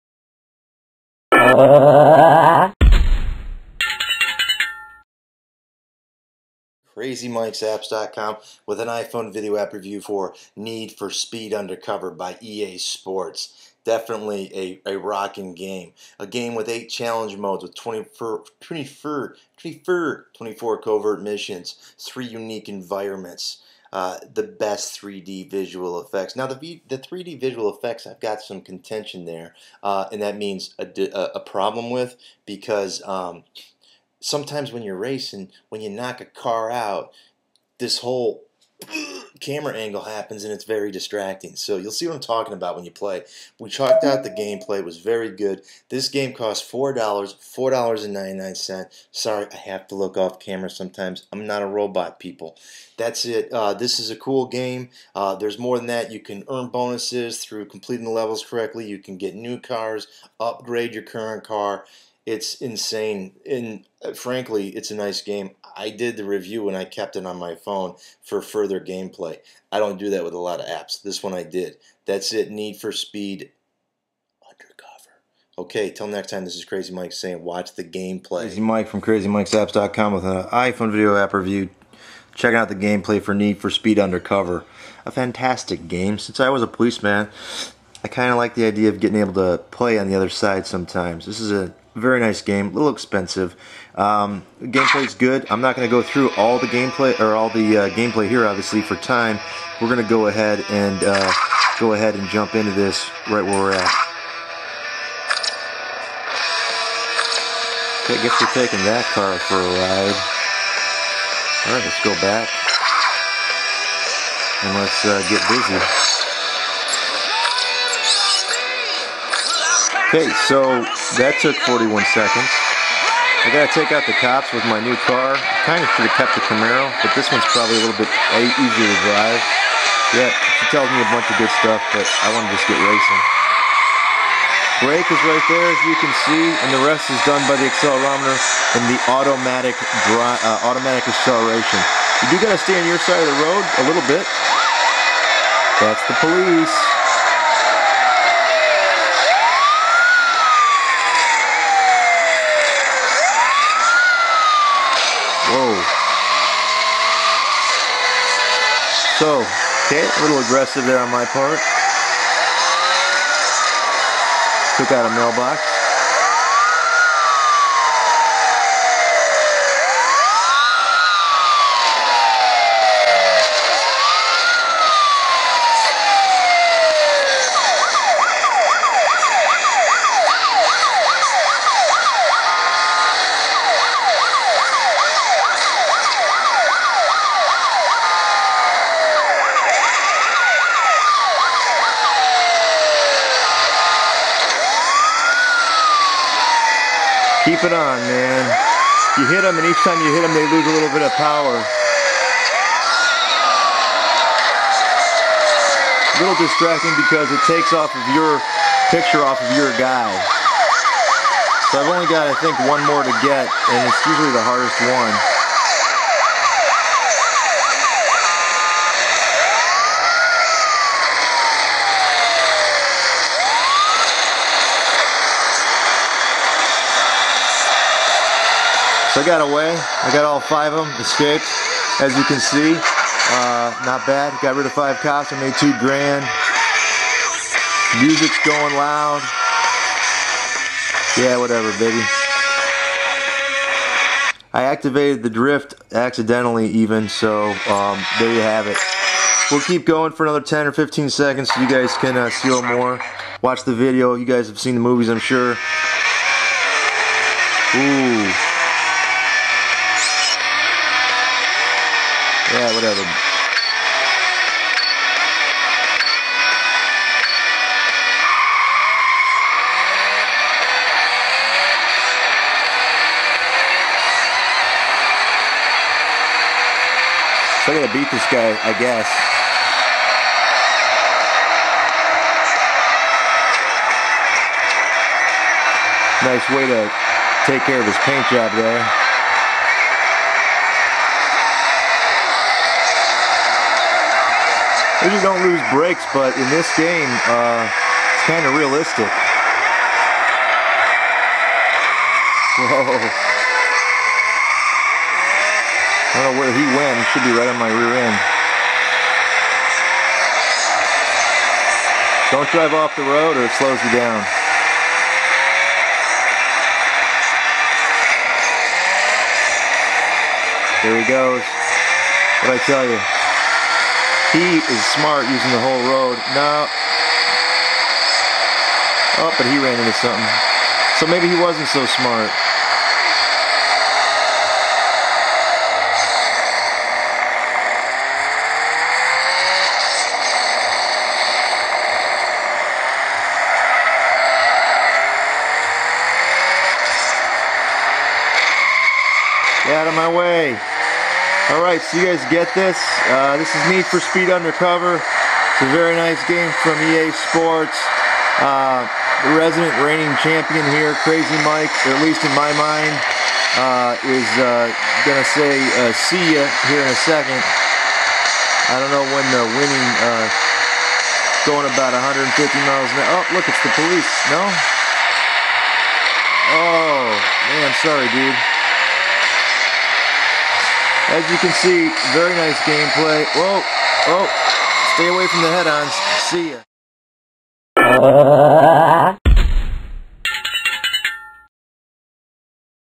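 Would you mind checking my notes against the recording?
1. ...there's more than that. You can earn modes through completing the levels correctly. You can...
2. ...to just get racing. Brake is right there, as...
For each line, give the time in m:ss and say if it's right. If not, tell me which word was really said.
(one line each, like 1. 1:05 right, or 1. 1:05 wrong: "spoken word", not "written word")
1. 0:55 wrong: "bonuses", not "modes"
2. 2:12 right.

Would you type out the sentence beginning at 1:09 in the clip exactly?
I don't do that with a lot of apps.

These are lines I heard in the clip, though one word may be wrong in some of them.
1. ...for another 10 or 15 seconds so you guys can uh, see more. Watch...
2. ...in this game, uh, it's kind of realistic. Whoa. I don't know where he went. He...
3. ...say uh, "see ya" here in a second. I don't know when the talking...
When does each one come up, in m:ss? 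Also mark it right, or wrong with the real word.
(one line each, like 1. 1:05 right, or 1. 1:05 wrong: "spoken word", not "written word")
1. 4:10 right
2. 4:56 right
3. 6:05 wrong: "winning", not "talking".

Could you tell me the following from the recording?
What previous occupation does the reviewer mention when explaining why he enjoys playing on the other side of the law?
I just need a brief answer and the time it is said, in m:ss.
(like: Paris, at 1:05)
Policeman, at 1:26.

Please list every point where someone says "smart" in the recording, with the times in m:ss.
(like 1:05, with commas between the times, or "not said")
5:24, 5:31.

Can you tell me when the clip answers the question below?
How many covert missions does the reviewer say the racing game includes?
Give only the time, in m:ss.
0:20.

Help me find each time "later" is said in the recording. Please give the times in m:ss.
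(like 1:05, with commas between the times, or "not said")
not said.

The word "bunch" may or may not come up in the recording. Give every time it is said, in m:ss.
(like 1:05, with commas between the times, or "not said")
2:11.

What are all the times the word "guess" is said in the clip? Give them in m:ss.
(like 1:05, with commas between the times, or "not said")
1:48, 4:38.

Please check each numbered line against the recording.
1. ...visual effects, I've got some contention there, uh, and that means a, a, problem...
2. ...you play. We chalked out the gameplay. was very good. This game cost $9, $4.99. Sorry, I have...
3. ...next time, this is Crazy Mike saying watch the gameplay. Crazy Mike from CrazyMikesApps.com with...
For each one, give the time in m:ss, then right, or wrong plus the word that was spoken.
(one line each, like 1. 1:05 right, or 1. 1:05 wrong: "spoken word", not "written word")
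1. 0:27 right
2. 0:42 wrong: "4", not "9"
3. 1:16 right.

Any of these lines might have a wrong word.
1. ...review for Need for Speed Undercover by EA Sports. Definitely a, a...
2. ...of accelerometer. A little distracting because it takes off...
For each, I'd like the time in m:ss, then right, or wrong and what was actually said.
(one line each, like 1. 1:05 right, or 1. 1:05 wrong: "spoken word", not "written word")
1. 0:09 right
2. 3:21 wrong: "power", not "accelerometer".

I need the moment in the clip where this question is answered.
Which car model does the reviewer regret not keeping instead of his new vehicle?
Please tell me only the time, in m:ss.
2:06.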